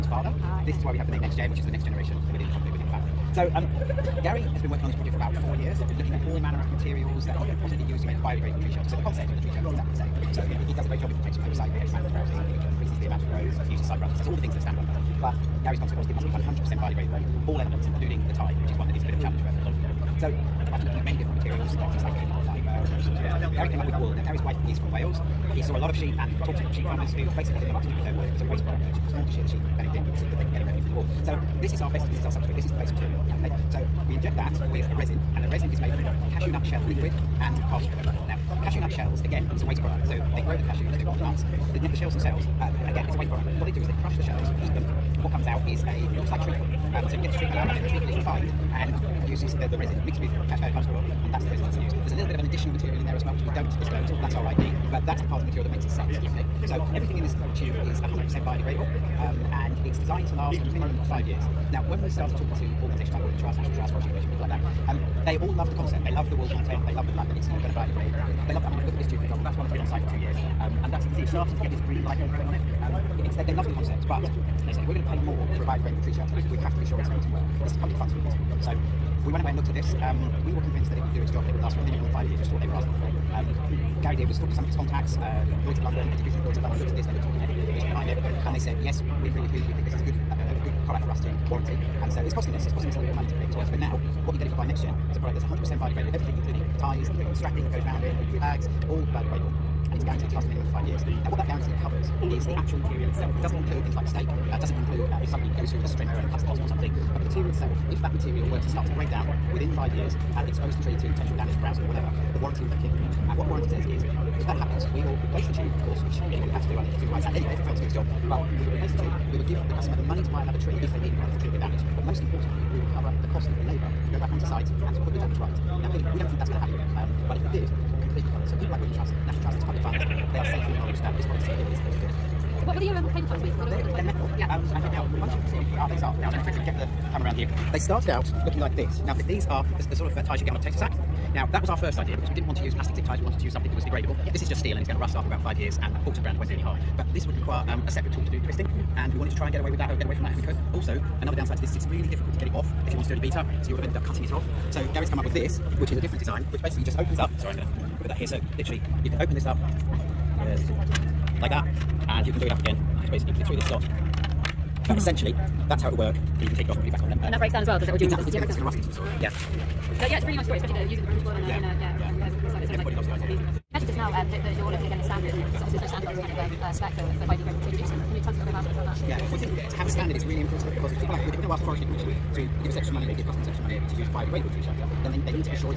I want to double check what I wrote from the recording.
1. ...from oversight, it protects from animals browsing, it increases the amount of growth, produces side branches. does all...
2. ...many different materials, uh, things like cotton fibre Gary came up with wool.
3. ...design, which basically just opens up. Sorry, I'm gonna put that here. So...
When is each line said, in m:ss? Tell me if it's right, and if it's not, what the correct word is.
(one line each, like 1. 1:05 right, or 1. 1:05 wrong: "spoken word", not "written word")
1. 0:11 right
2. 0:21 right
3. 2:36 right.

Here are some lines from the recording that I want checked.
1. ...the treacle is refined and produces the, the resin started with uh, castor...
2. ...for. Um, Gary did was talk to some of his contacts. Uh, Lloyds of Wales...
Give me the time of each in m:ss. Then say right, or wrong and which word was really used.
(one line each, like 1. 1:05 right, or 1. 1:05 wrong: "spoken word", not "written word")
1. 0:47 wrong: "mixed", not "started"
2. 1:22 wrong: "London", not "Wales".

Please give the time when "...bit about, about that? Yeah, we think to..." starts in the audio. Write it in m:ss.
2:58.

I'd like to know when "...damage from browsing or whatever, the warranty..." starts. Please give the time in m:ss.
1:51.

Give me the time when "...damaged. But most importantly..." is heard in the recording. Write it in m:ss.
2:01.